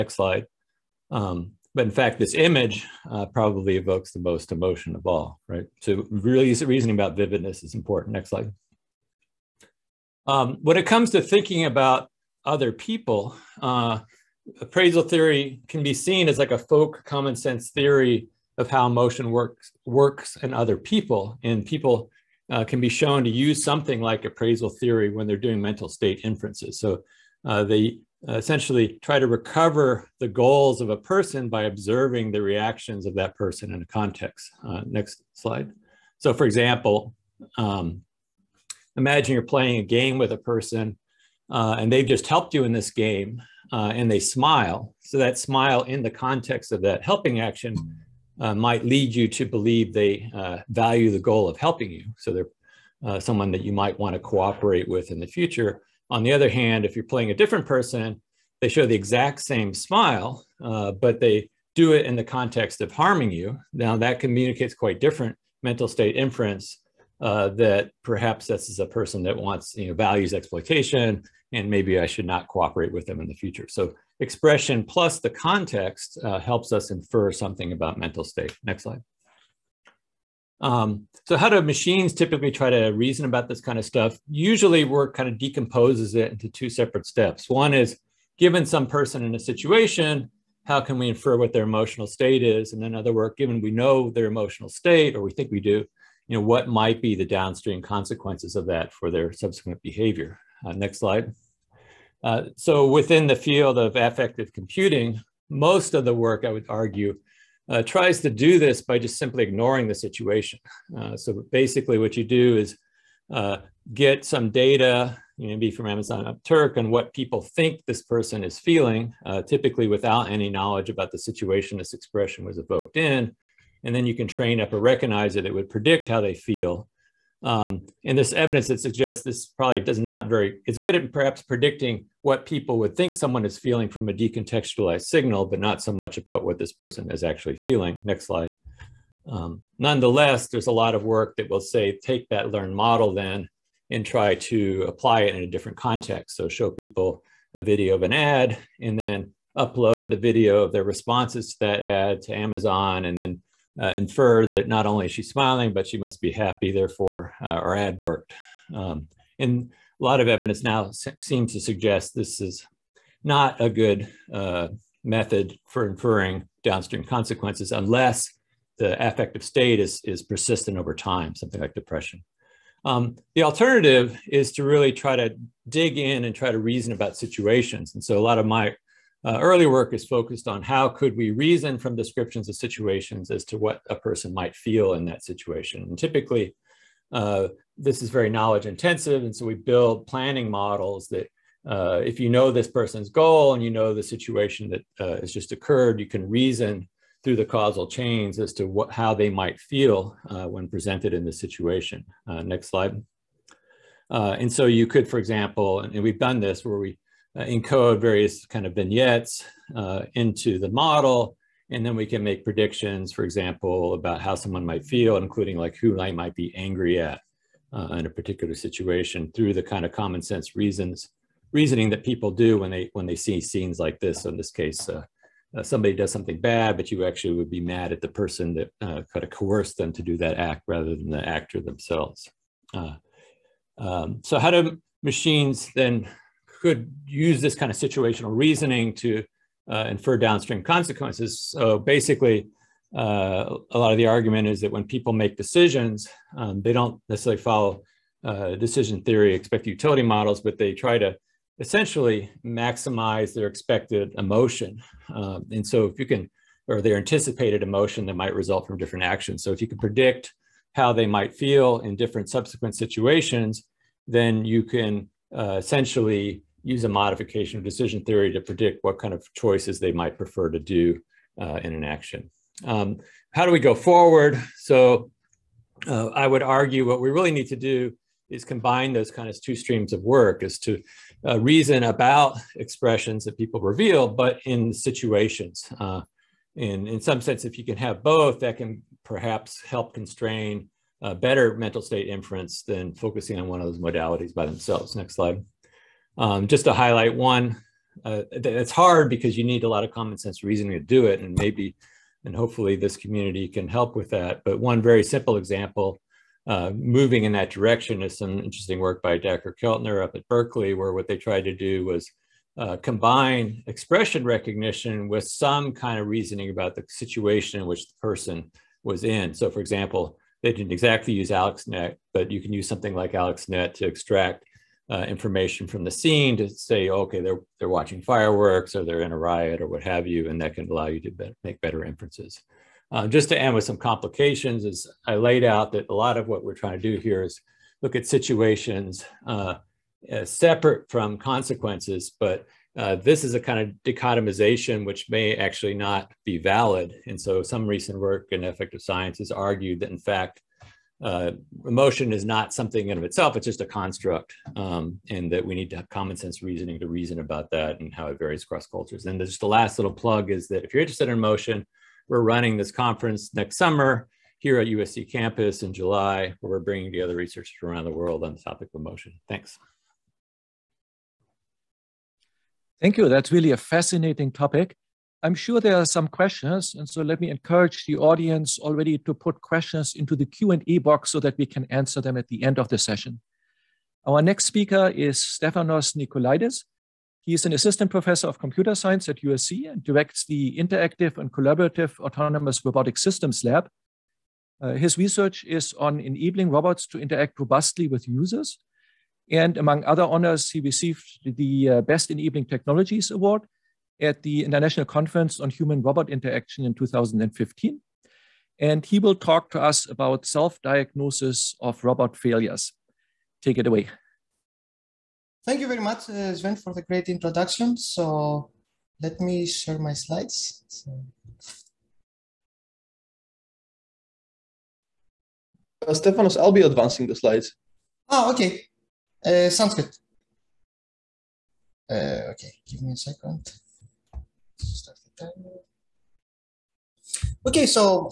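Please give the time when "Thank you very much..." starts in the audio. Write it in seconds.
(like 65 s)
415 s.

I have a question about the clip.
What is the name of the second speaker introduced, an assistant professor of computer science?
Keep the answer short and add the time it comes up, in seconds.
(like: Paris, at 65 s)
Stefanos Nikolaidis, at 385 s.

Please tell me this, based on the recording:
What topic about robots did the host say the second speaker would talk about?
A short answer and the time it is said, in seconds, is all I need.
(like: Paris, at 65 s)
self diagnosis of robot failures, at 410 s.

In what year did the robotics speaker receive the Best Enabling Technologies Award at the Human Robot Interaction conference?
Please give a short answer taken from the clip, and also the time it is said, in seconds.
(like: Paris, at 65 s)
2015, at 406 s.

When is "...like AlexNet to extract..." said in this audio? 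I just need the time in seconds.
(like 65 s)
322 s.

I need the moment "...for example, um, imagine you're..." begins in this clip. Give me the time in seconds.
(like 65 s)
36 s.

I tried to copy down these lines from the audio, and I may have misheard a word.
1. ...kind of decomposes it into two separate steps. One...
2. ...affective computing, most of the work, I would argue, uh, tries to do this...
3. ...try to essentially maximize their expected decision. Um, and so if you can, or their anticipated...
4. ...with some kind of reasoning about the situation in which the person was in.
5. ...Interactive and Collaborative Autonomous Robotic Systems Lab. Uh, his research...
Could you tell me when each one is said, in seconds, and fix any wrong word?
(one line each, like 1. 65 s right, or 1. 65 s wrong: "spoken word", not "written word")
1. 85 s right
2. 103 s right
3. 250 s wrong: "emotion", not "decision"
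4. 315 s right
5. 390 s right.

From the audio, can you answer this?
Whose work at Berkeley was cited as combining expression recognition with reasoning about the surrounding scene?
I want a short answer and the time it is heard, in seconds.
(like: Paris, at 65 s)
Dacher Keltner, at 309 s.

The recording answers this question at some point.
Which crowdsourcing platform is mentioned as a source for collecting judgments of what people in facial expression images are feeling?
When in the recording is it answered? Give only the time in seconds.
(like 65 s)
115 s.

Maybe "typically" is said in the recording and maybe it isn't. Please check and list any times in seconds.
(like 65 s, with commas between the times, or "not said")
82 s, 119 s, 185 s.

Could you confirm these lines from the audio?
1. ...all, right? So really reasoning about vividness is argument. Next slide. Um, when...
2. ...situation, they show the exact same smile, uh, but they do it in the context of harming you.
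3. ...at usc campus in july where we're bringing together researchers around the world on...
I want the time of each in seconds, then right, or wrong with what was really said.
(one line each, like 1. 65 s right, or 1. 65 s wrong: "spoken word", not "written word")
1. 5 s wrong: "important", not "argument"
2. 57 s wrong: "person", not "situation"
3. 364 s right.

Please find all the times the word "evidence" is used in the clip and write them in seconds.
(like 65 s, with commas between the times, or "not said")
128 s, 160 s.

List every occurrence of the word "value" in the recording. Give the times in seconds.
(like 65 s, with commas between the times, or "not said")
50 s, 69 s.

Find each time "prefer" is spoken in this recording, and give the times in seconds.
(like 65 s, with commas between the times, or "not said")
270 s.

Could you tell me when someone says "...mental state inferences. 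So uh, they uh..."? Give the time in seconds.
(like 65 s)
25 s.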